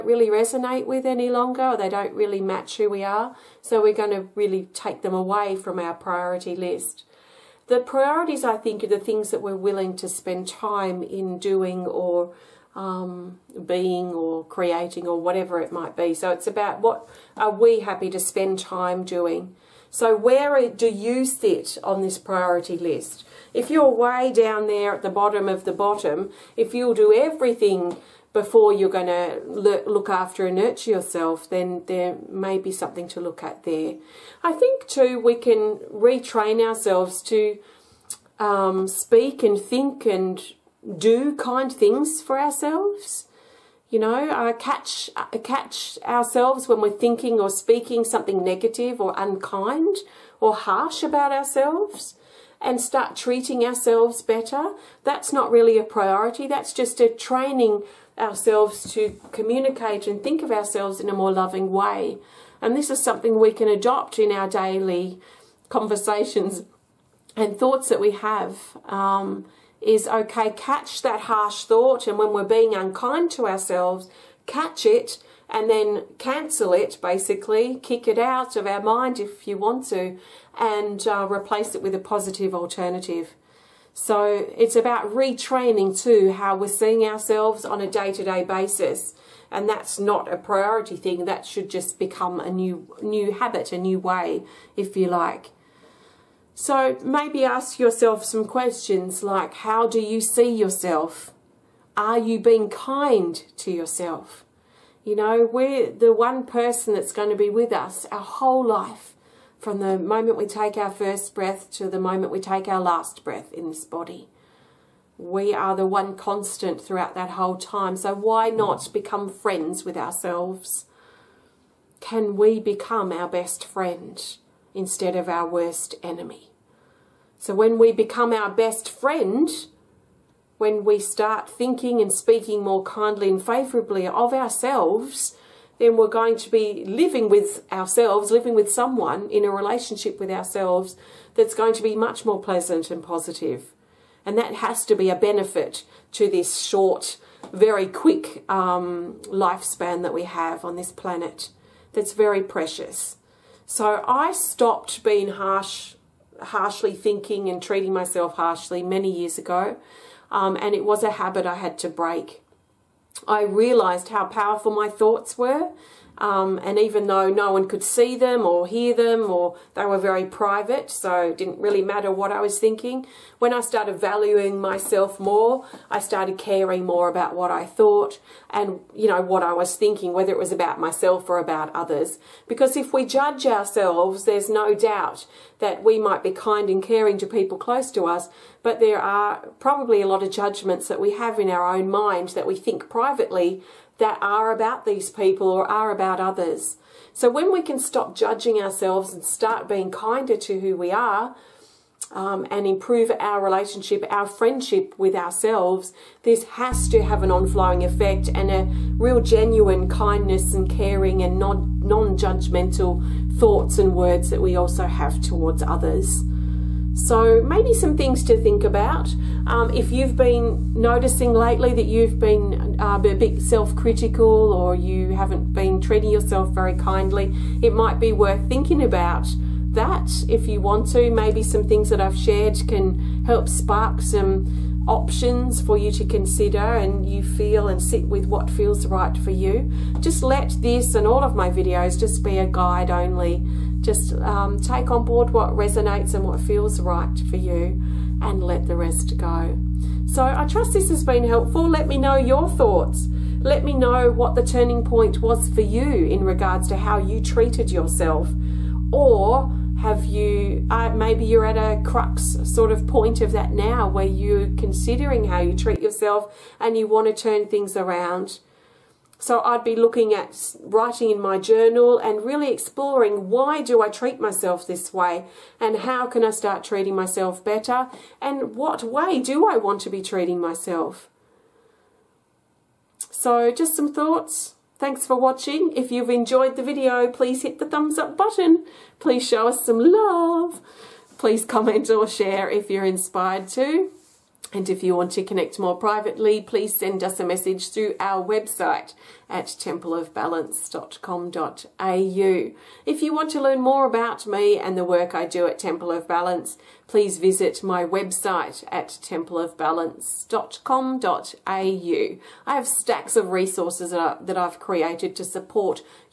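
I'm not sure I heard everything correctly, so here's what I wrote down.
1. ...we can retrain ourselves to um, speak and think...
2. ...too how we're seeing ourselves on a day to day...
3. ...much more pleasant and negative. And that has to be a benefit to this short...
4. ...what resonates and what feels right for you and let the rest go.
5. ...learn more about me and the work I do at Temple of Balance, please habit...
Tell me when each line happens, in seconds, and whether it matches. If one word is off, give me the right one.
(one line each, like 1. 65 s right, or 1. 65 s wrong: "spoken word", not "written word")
1. 35 s right
2. 86 s right
3. 141 s wrong: "positive", not "negative"
4. 245 s right
5. 303 s wrong: "visit", not "habit".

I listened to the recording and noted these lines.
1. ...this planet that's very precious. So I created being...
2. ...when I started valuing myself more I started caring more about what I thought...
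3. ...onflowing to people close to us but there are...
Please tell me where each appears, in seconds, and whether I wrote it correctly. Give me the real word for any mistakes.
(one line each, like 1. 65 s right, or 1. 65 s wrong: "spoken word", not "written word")
1. 150 s wrong: "stopped", not "created"
2. 173 s right
3. 186 s wrong: "caring", not "onflowing".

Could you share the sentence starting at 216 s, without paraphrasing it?
So, maybe some things to think about.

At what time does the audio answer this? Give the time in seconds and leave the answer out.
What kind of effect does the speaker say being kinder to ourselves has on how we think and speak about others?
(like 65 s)
207 s.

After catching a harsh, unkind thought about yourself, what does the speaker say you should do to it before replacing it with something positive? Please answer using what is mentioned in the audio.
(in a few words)
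Cancel it.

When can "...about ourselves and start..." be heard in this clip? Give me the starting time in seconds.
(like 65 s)
51 s.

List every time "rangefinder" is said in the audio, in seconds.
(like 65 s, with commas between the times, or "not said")
not said.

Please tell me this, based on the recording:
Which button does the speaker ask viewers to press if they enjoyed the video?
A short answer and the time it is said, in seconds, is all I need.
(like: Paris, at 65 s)
Thumbs up, at 287 s.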